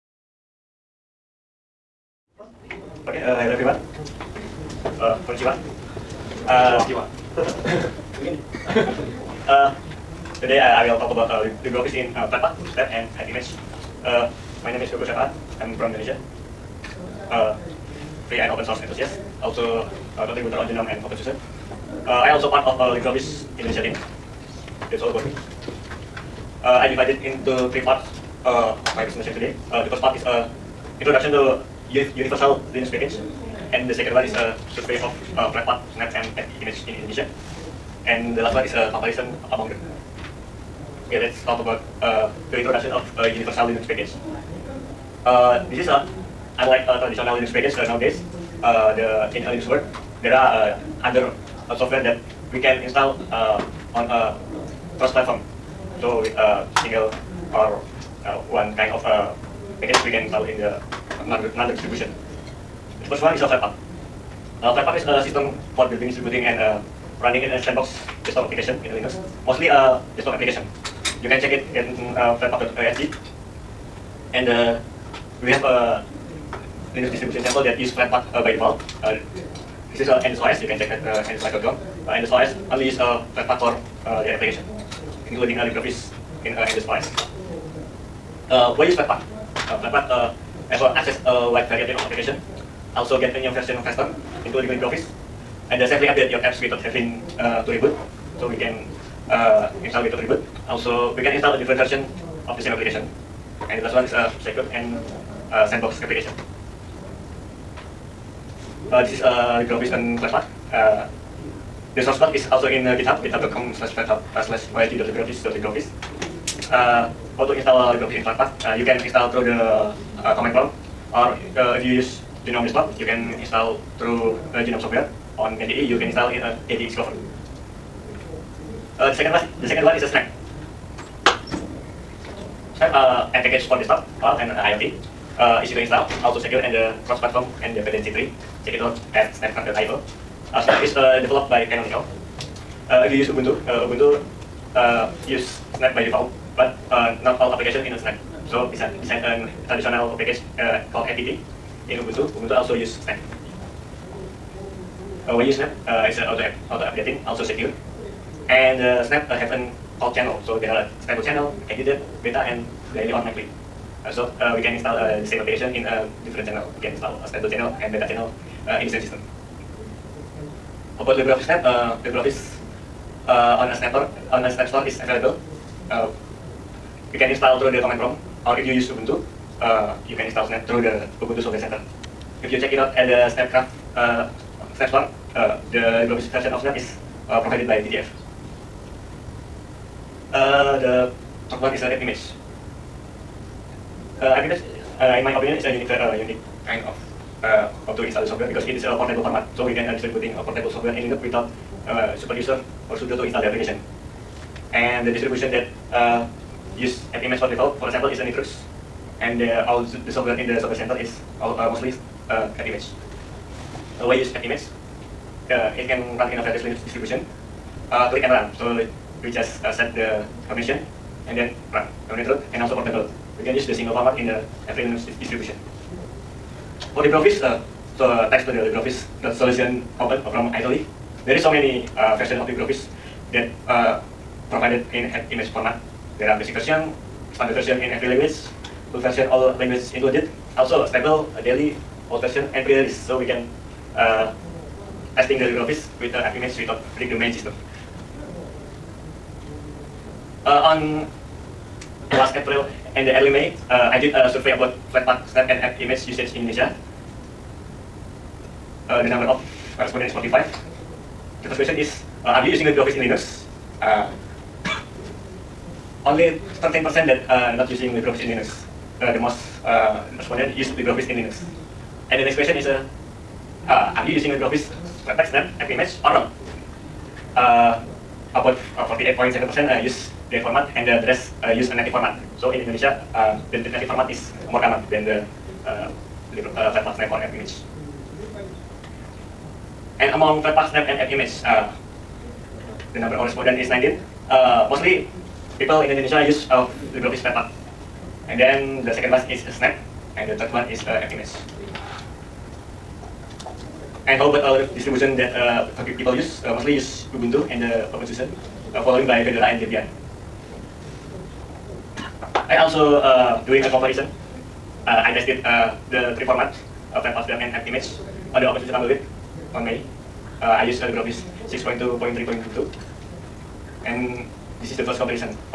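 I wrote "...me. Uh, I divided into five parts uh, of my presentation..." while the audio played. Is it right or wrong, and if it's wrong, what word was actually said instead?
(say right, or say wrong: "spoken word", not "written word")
wrong: "three", not "five".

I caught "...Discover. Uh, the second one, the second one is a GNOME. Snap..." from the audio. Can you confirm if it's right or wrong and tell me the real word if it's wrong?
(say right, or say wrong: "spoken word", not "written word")
wrong: "Snap", not "GNOME".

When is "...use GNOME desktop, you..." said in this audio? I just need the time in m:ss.
2:01.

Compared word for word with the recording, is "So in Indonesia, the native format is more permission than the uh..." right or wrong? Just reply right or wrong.
wrong.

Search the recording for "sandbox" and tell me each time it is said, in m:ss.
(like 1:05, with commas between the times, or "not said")
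1:07, 1:45.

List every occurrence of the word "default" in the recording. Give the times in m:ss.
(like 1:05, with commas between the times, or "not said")
1:18, 2:26, 3:27.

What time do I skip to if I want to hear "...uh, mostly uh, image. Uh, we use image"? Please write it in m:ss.
3:31.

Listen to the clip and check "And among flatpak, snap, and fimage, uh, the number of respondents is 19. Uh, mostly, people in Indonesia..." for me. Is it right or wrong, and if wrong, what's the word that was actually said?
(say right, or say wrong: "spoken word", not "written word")
right.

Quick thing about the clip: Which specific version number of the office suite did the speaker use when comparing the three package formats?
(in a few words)
6.2.3.2.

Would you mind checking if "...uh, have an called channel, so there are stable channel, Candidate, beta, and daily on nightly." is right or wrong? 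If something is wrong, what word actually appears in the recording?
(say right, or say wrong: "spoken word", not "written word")
right.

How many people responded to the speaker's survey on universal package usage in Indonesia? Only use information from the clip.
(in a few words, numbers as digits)
45.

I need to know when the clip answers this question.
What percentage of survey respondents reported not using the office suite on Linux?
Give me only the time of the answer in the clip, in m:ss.
4:26.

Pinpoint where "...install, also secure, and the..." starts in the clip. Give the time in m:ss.
2:15.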